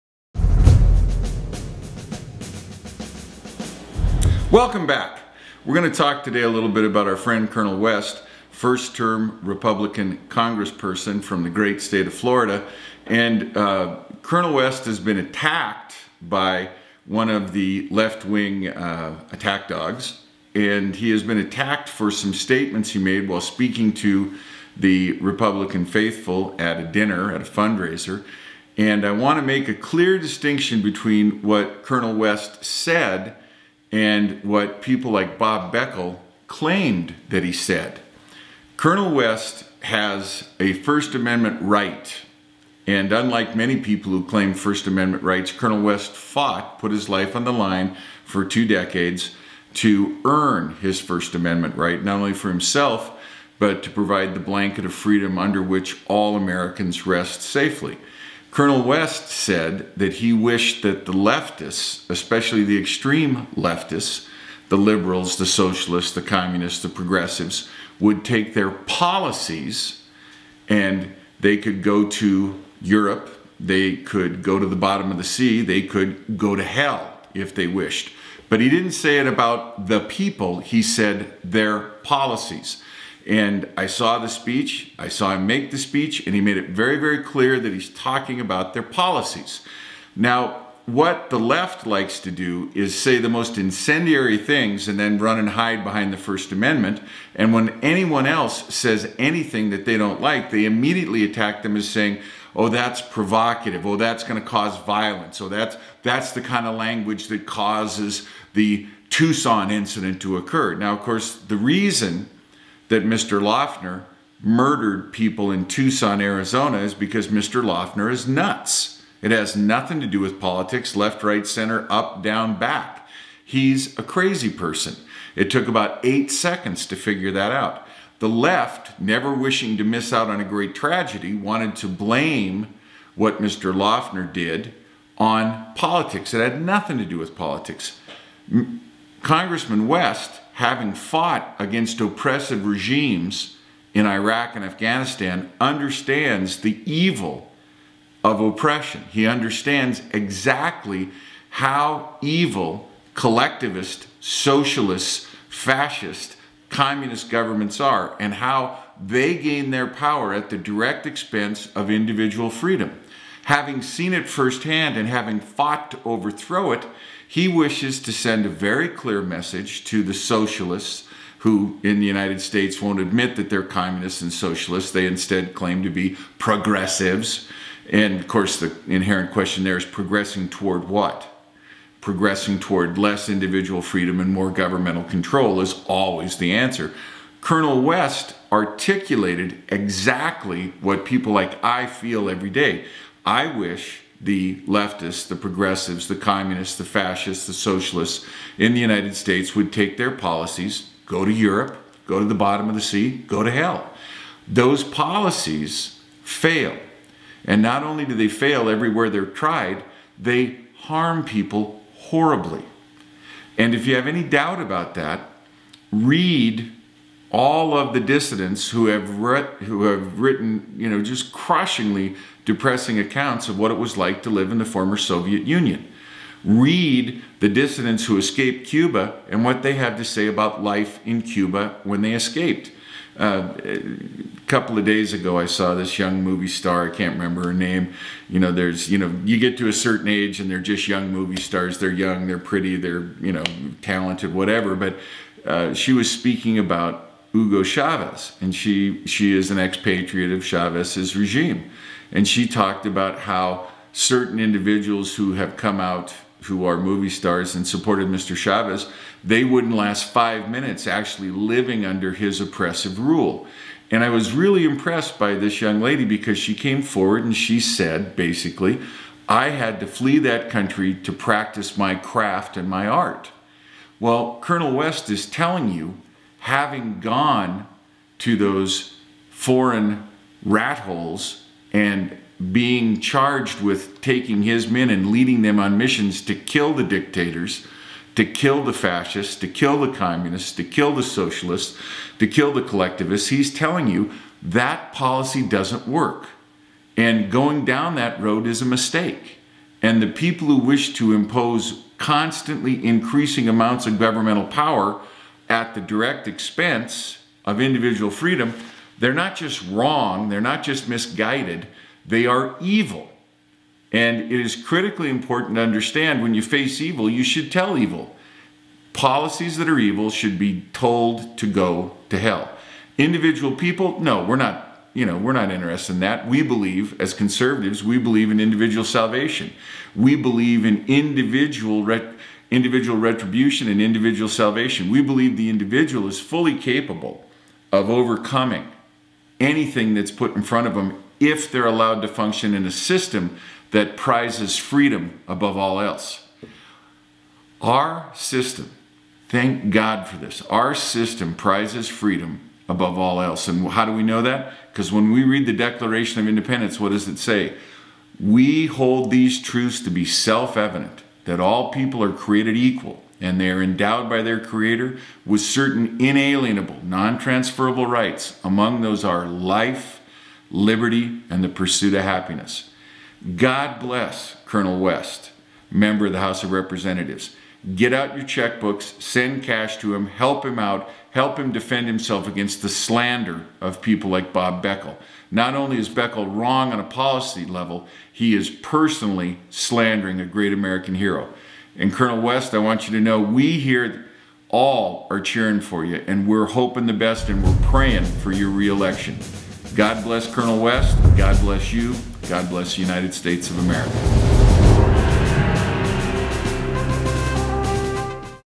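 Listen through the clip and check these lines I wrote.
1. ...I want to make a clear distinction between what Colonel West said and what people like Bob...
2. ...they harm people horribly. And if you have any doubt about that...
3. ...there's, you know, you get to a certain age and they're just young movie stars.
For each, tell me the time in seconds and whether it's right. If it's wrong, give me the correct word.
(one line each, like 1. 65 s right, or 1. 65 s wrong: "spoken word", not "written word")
1. 29 s right
2. 210 s right
3. 238 s right.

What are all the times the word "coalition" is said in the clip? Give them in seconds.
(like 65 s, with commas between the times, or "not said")
not said.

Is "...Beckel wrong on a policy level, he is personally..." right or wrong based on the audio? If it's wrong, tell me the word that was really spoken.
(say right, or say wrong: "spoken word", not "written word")
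right.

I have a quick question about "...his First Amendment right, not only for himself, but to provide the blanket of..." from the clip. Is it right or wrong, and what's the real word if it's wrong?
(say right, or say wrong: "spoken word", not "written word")
right.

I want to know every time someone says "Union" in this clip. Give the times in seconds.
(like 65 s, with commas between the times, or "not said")
225 s.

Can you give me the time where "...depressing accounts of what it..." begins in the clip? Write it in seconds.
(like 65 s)
222 s.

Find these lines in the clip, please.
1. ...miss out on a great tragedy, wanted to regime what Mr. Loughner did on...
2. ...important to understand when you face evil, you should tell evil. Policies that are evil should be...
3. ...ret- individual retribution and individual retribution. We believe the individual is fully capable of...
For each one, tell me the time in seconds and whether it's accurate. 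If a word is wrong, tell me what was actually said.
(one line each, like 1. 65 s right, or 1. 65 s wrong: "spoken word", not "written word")
1. 129 s wrong: "blame", not "regime"
2. 315 s right
3. 331 s wrong: "salvation", not "retribution".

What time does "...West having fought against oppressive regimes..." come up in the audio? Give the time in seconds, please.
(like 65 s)
139 s.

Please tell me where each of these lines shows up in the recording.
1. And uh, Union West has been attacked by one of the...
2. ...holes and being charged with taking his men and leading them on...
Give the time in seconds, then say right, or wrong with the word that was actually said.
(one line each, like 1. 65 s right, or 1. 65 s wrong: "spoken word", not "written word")
1. 13 s wrong: "Colonel", not "Union"
2. 280 s right.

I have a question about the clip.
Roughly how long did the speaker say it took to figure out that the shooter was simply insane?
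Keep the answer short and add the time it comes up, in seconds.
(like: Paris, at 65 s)
8 seconds, at 126 s.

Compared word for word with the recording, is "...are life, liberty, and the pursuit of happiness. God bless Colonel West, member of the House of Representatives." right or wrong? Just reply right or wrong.
right.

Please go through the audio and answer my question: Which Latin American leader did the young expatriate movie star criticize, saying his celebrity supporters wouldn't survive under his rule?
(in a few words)
Hugo Chavez.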